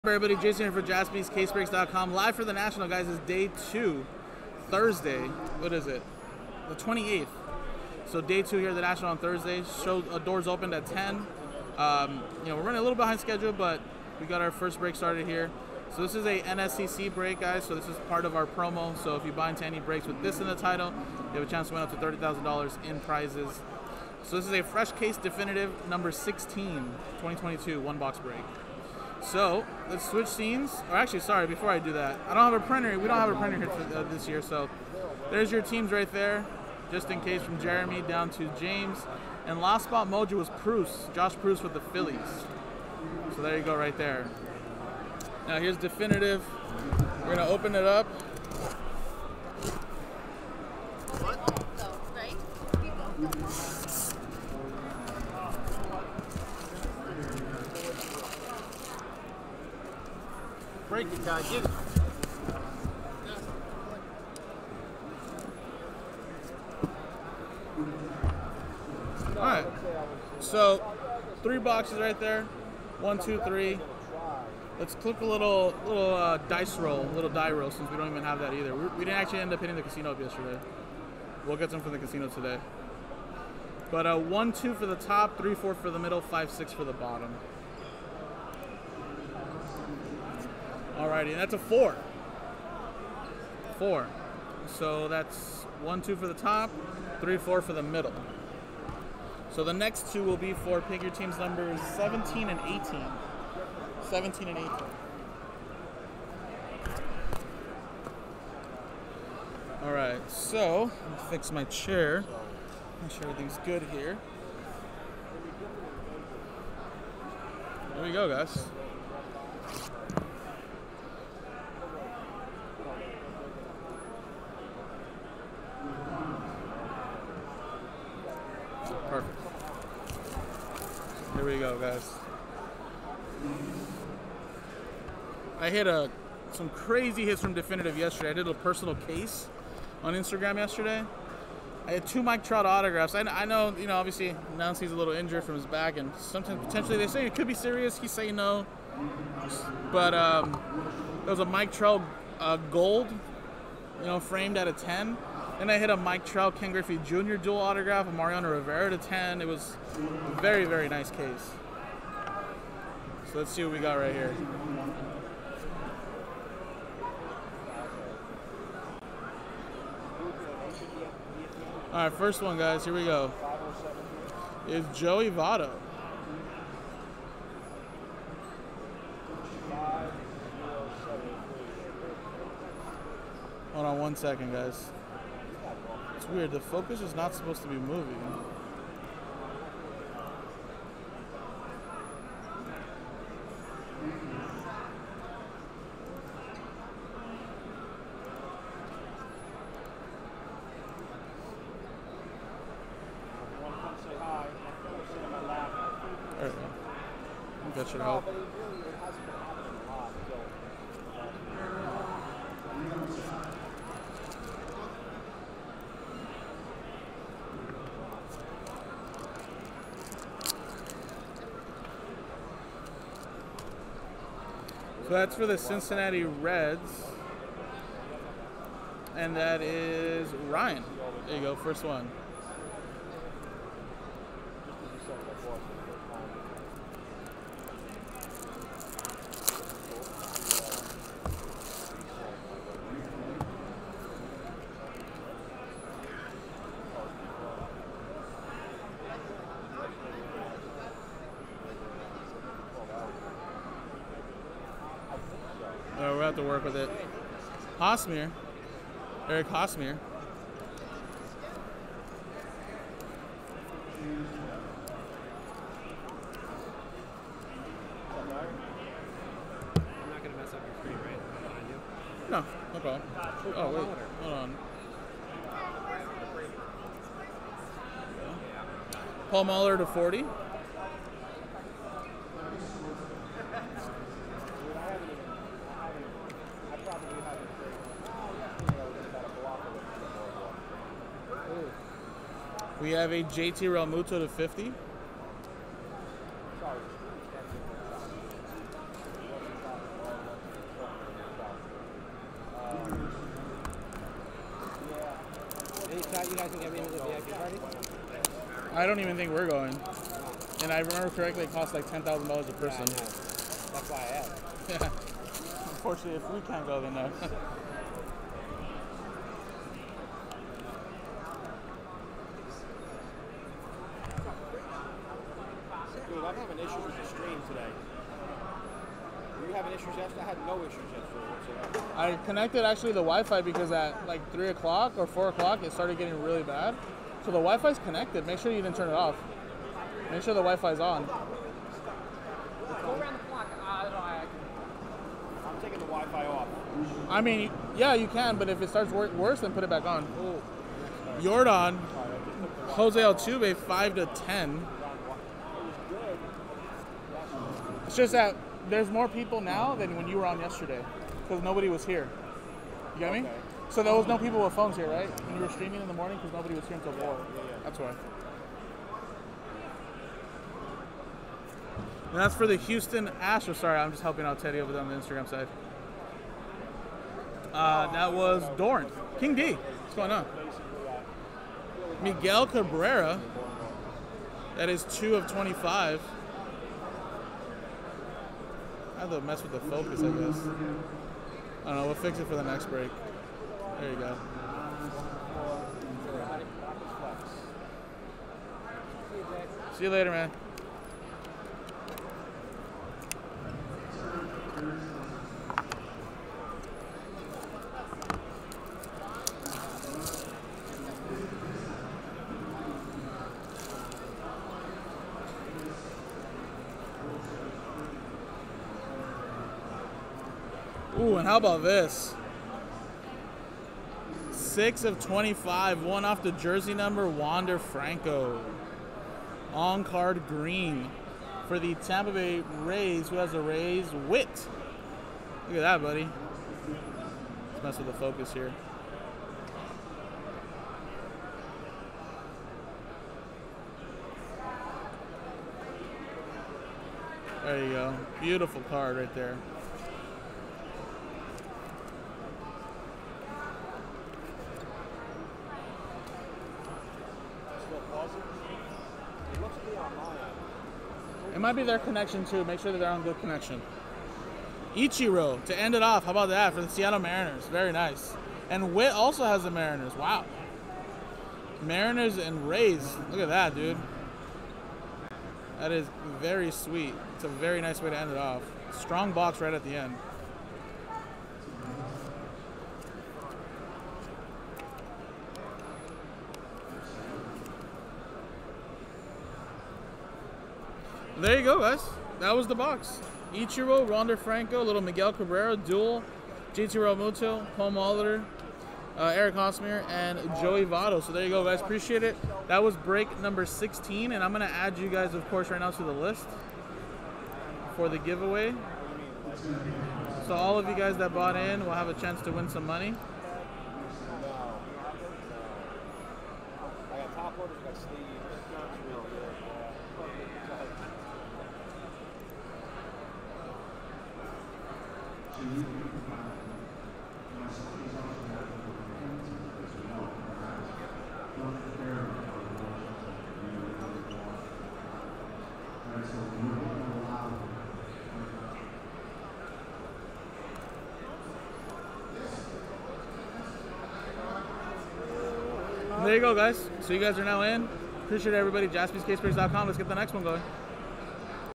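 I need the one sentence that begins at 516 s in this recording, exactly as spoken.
I got top orders, I got sleeves.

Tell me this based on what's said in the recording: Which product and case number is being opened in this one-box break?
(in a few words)
Definitive number 16.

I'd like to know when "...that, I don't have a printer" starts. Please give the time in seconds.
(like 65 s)
31 s.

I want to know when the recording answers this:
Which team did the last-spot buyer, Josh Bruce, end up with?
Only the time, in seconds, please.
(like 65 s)
41 s.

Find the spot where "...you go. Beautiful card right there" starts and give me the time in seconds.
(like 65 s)
447 s.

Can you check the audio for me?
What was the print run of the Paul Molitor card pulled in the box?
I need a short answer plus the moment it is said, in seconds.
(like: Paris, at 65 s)
40, at 279 s.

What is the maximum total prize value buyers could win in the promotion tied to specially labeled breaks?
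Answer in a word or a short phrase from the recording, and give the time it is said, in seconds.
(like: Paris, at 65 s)
$30,000, at 21 s.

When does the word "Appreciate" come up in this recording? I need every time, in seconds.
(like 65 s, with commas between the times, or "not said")
501 s, 548 s.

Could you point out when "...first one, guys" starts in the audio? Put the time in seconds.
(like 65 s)
172 s.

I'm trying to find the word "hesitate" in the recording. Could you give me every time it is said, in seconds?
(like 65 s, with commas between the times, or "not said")
not said.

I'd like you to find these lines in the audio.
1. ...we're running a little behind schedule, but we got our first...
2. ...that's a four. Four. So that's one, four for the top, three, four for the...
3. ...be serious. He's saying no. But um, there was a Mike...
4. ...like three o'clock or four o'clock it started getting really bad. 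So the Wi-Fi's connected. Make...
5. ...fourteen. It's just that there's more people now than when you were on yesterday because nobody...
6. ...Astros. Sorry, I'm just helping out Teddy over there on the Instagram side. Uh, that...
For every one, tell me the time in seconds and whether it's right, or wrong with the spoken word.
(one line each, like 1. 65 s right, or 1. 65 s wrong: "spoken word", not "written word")
1. 12 s right
2. 91 s wrong: "two", not "four"
3. 147 s right
4. 334 s right
5. 354 s wrong: "ten", not "fourteen"
6. 373 s right.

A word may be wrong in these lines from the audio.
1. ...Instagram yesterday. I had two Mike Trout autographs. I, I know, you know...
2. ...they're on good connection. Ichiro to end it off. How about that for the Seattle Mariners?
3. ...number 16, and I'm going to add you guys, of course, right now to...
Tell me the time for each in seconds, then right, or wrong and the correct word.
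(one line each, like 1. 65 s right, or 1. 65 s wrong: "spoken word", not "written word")
1. 140 s right
2. 462 s right
3. 503 s right.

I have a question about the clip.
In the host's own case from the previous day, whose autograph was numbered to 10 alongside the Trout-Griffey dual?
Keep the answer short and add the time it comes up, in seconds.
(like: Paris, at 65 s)
Mariano Rivera, at 158 s.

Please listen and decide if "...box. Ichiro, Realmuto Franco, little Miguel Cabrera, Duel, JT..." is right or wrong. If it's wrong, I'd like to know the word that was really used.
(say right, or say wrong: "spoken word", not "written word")
wrong: "Wander", not "Realmuto".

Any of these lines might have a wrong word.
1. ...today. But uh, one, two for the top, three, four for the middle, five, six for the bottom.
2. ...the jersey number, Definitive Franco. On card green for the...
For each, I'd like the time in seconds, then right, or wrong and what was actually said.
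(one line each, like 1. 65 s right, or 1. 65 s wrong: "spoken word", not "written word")
1. 82 s right
2. 426 s wrong: "Wander", not "Definitive".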